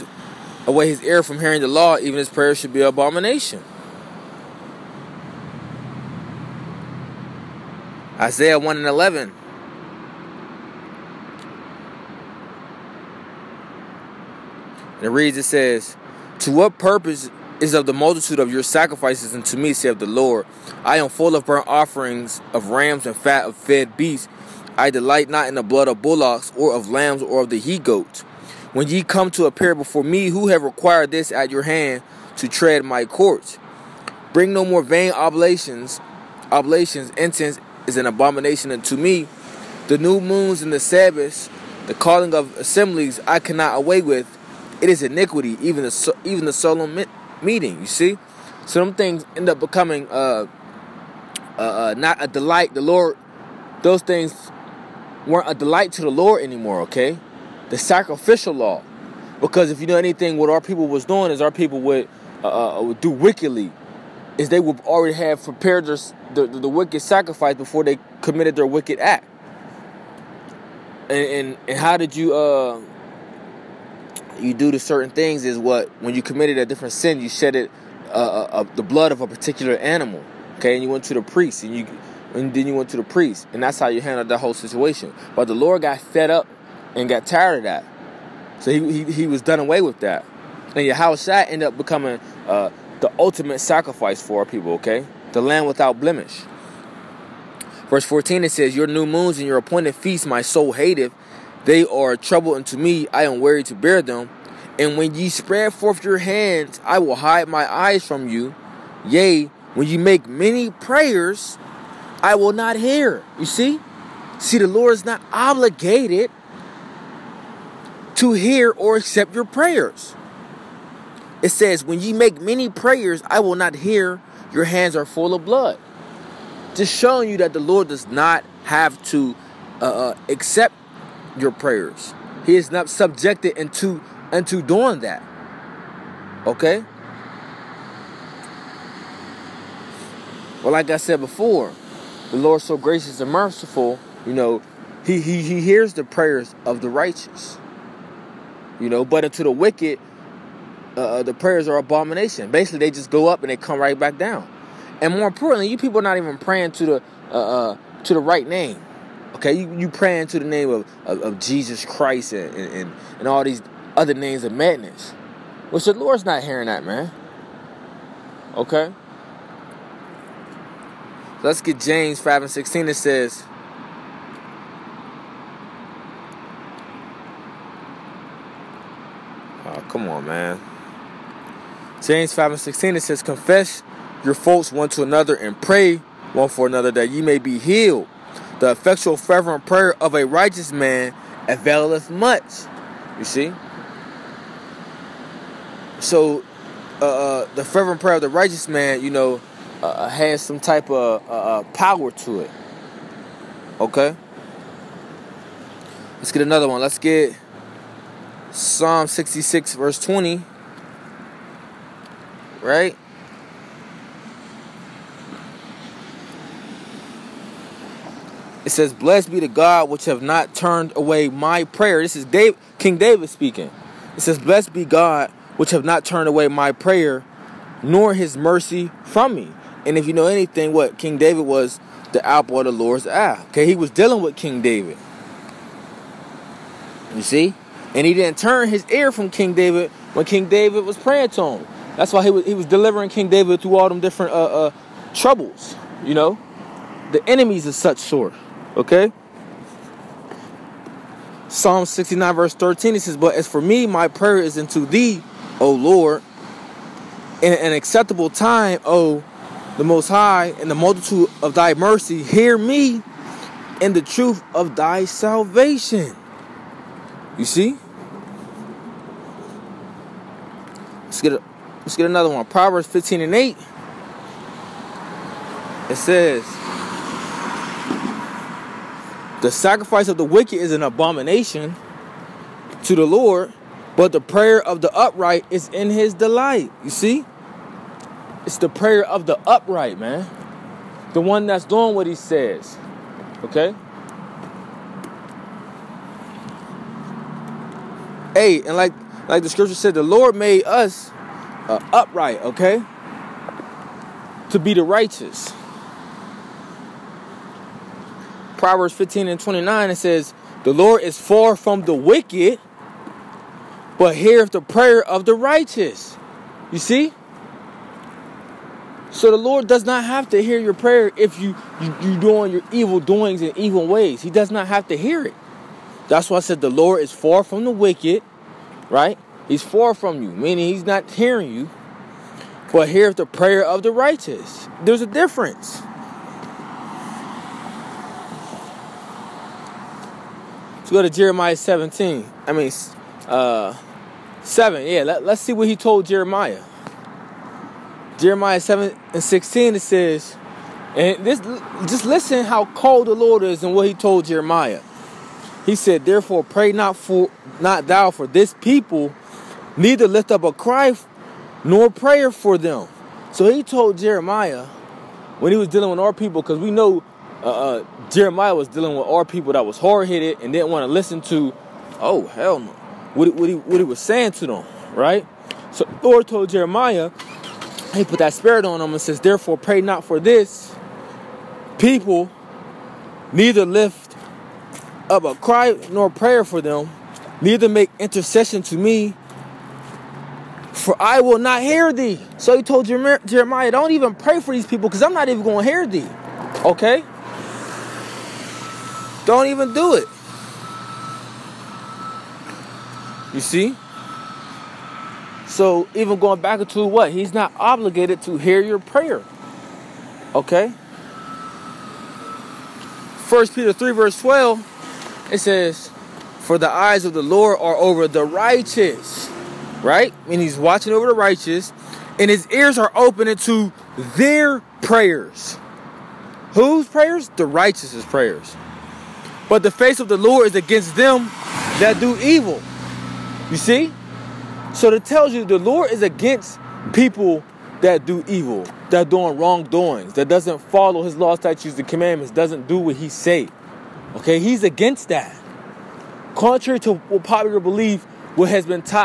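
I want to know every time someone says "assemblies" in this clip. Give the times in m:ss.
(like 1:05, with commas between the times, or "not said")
0:42.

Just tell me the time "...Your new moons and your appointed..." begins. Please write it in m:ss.
1:38.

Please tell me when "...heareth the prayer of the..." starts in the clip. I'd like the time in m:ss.
5:14.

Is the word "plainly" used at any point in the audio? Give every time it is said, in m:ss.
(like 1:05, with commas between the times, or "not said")
not said.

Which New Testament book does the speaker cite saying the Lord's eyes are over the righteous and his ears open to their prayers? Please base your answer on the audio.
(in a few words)
First Peter.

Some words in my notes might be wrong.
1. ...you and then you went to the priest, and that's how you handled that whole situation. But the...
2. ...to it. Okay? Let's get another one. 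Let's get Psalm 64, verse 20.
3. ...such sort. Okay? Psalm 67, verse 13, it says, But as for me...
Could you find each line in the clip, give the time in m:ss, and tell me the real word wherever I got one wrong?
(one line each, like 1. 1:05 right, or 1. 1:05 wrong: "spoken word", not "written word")
1. 1:21 right
2. 3:22 wrong: "66", not "64"
3. 4:07 wrong: "69", not "67".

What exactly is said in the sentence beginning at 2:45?
Well, the Lord's not hearing that, man.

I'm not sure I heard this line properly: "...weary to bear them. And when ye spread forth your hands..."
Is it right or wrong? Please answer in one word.
right.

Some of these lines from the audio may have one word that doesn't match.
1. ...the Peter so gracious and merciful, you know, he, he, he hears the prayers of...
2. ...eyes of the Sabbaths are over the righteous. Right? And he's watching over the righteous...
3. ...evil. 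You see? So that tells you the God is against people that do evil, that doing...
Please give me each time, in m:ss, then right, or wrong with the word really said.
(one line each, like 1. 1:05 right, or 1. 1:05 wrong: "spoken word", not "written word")
1. 2:22 wrong: "Lord", not "Peter"
2. 6:56 wrong: "Lord", not "Sabbaths"
3. 7:12 wrong: "Lord", not "God".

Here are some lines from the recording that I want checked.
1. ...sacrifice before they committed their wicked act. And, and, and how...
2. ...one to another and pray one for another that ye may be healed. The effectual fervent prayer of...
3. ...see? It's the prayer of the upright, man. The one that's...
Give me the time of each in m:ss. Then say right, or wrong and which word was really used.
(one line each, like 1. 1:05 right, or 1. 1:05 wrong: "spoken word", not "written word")
1. 1:07 right
2. 3:04 right
3. 4:46 right.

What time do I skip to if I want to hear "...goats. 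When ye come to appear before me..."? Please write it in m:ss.
0:27.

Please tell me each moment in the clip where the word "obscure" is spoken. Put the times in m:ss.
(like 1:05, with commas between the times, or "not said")
not said.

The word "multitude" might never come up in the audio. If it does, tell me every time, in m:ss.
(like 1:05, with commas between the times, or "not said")
0:17, 4:20.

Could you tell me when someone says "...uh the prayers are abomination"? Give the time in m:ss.
2:31.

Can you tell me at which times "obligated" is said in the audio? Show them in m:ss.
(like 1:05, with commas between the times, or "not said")
1:55, 6:47.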